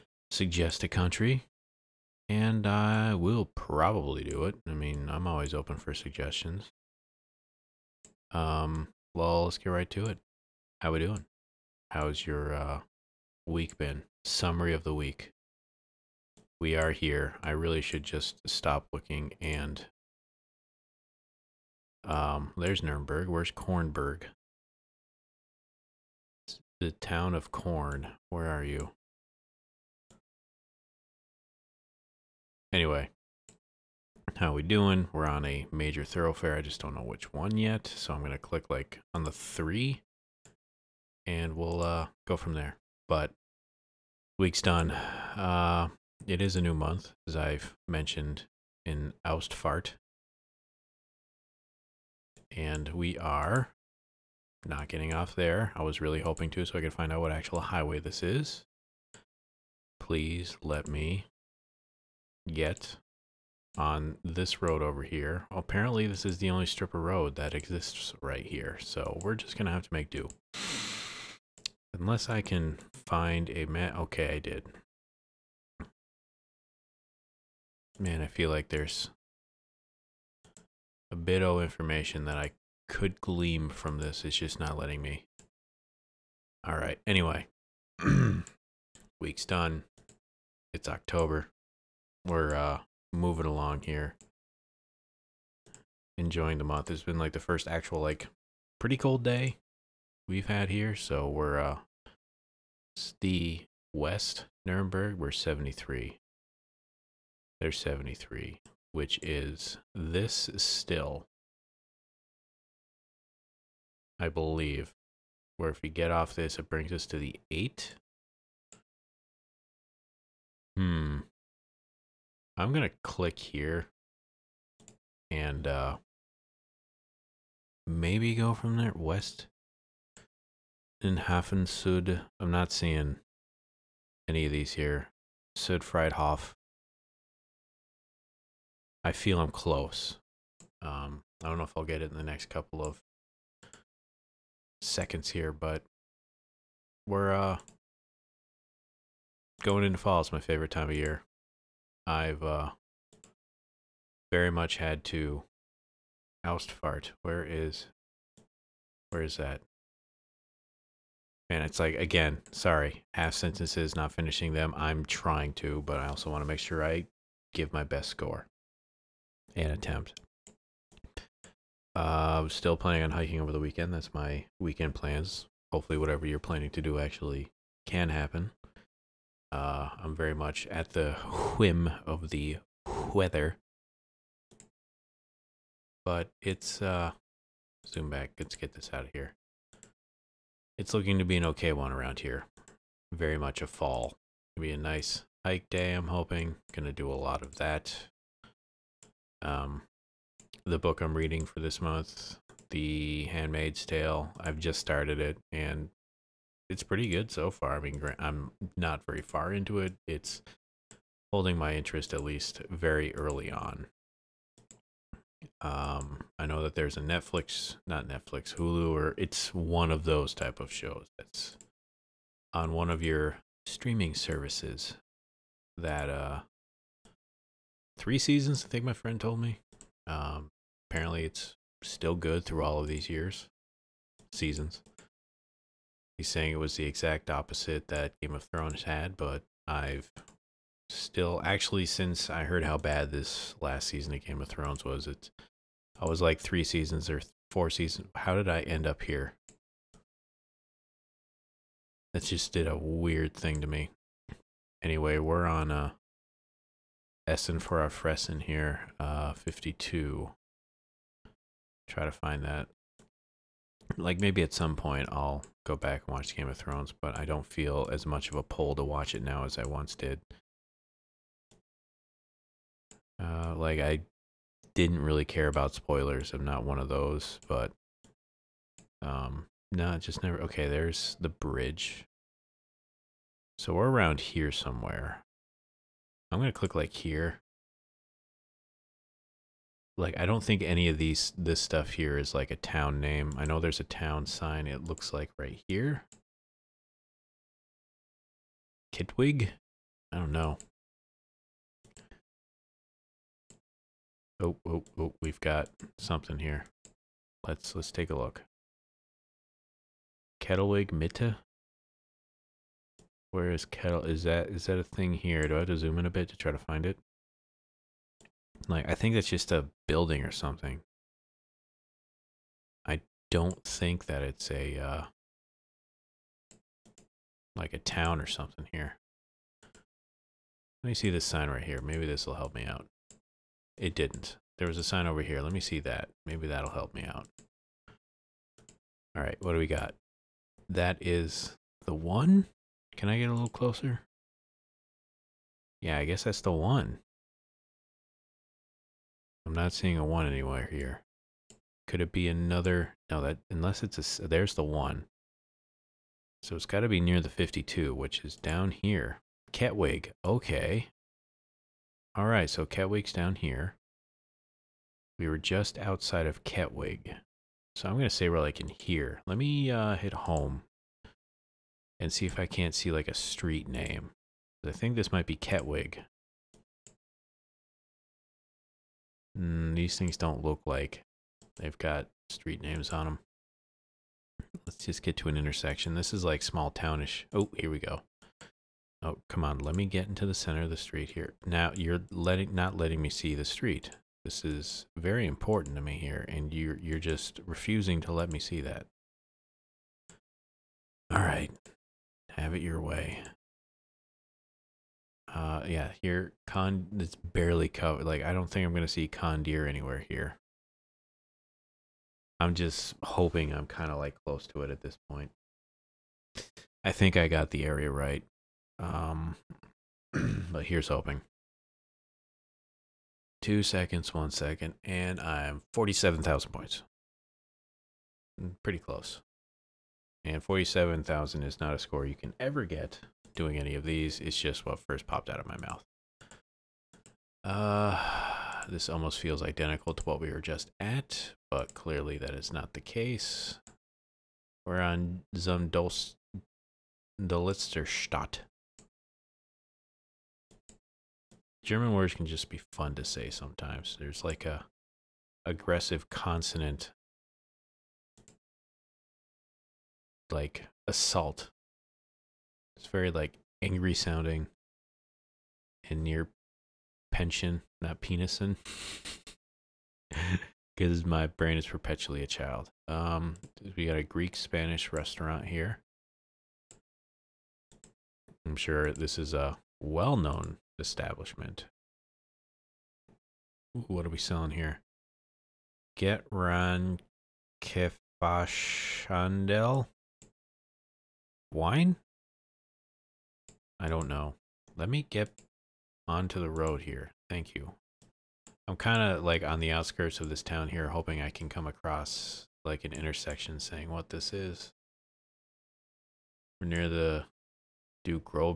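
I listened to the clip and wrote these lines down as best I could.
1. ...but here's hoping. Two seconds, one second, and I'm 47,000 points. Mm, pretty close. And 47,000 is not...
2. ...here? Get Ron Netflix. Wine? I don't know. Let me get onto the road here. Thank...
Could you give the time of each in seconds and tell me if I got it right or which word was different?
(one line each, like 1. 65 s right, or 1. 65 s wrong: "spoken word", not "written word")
1. 420 s right
2. 484 s wrong: "Kefashandel", not "Netflix".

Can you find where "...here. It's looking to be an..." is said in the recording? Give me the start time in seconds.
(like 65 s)
189 s.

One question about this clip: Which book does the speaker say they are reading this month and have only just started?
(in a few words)
The Handmaid's Tale.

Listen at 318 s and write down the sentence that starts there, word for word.
Like, I think that's just a building or something.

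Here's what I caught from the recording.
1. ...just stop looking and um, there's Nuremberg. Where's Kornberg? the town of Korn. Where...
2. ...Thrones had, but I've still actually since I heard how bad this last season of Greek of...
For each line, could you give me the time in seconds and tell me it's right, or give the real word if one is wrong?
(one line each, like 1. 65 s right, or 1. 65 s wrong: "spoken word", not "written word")
1. 18 s right
2. 238 s wrong: "Game", not "Greek".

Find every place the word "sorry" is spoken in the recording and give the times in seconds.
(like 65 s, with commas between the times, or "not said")
162 s.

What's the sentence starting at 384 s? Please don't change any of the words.
Let's just get to an intersection.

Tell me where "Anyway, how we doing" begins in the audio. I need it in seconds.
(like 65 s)
32 s.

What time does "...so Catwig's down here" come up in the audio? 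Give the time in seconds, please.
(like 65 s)
362 s.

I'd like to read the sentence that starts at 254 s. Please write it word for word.
Anyway, we're on uh Essen for our Fressen here, uh, 52.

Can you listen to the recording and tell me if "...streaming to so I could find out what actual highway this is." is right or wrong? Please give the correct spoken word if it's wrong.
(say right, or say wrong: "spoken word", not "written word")
wrong: "hoping", not "streaming".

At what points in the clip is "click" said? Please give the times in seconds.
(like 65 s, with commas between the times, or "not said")
38 s, 123 s, 286 s.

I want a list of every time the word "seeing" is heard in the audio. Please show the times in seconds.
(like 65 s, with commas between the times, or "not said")
132 s, 349 s.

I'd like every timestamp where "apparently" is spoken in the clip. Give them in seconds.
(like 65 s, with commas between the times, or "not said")
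65 s, 230 s.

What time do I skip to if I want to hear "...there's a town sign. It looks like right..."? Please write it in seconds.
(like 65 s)
293 s.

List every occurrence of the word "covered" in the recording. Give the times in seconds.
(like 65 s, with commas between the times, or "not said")
407 s.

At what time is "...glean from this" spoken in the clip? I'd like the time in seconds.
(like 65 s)
83 s.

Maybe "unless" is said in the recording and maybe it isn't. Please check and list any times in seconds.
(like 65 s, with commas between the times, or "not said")
71 s, 353 s.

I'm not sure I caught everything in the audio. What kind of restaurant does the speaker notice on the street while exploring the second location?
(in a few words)
Greek Spanish.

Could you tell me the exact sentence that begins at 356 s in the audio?
So it's got to be near the 52, which is down here.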